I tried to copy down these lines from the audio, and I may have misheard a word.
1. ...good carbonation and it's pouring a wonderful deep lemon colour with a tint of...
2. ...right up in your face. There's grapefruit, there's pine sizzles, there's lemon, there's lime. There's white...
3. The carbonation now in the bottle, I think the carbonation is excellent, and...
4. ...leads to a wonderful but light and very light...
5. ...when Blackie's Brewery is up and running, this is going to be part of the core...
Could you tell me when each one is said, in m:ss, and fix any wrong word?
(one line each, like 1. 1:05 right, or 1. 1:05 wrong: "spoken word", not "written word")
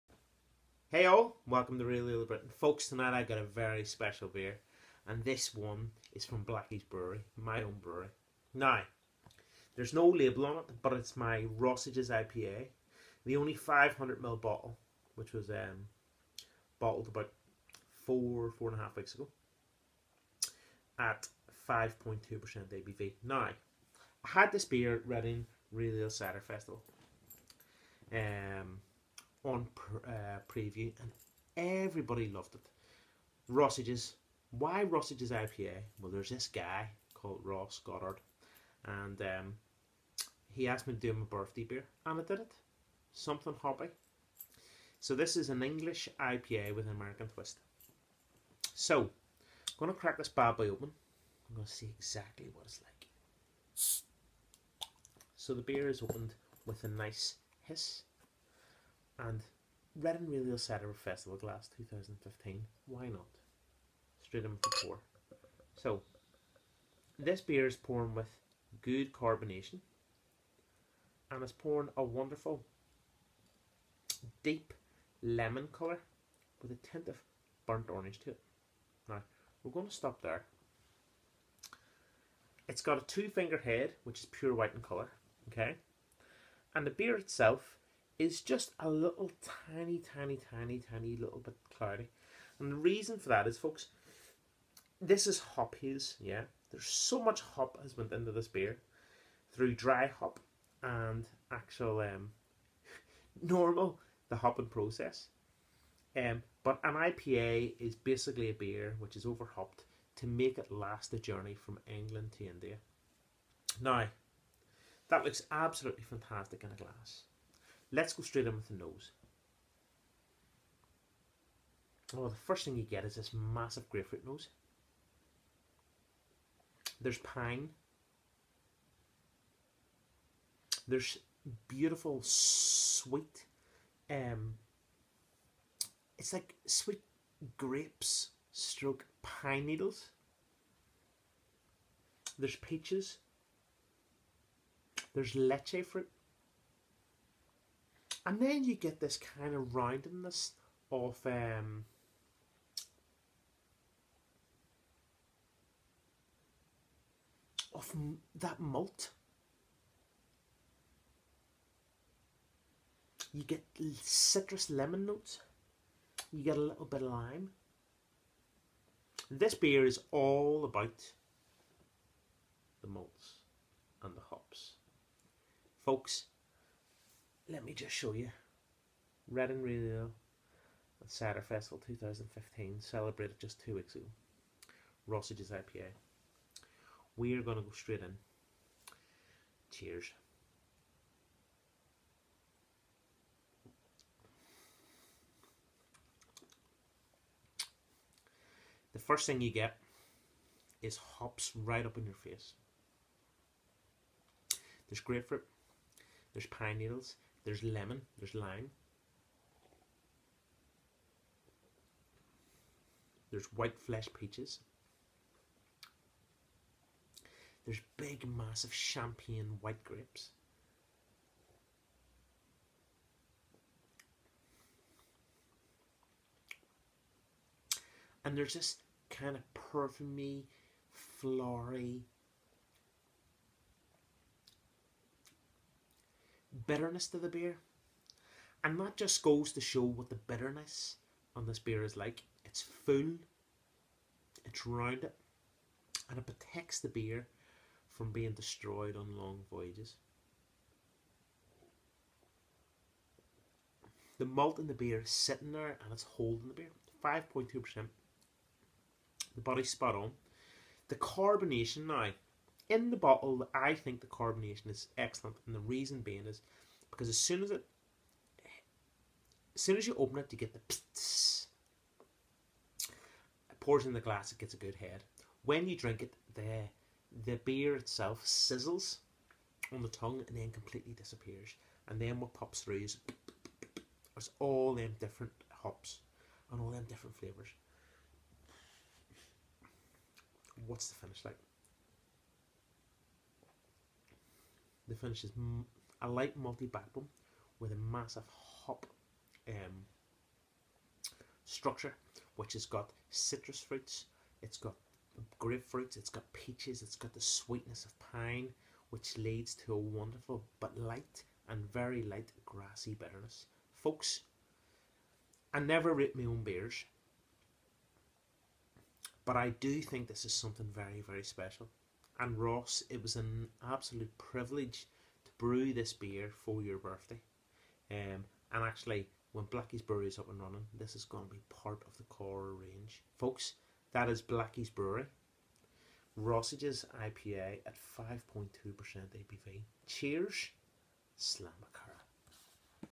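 1. 1:08 right
2. 3:21 wrong: "needles", not "sizzles"
3. 4:20 right
4. 5:09 right
5. 5:29 right.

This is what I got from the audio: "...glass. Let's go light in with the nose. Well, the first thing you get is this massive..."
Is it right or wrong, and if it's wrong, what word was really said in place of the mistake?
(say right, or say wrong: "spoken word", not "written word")
wrong: "straight", not "light".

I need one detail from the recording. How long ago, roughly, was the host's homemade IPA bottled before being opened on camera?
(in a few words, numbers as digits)
four and a half weeks.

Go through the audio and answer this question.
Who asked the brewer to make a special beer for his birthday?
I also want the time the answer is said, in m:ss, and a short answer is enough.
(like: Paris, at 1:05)
Ross Goddard, at 0:37.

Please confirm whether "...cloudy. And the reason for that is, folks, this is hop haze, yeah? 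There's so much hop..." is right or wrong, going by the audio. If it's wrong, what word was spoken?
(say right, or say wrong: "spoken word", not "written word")
right.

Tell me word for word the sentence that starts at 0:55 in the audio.
So the beer is opened with a nice hiss.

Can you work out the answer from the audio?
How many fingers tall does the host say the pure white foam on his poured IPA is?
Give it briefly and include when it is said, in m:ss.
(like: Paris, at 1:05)
2, at 1:23.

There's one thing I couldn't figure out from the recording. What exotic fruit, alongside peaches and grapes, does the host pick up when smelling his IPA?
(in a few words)
lychee.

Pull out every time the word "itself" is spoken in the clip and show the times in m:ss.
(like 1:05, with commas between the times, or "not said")
1:27, 4:37.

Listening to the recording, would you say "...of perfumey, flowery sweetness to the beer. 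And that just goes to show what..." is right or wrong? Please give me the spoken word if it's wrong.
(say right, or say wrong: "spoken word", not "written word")
wrong: "bitterness", not "sweetness".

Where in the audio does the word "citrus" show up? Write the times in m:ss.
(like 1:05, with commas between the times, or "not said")
2:44, 5:03.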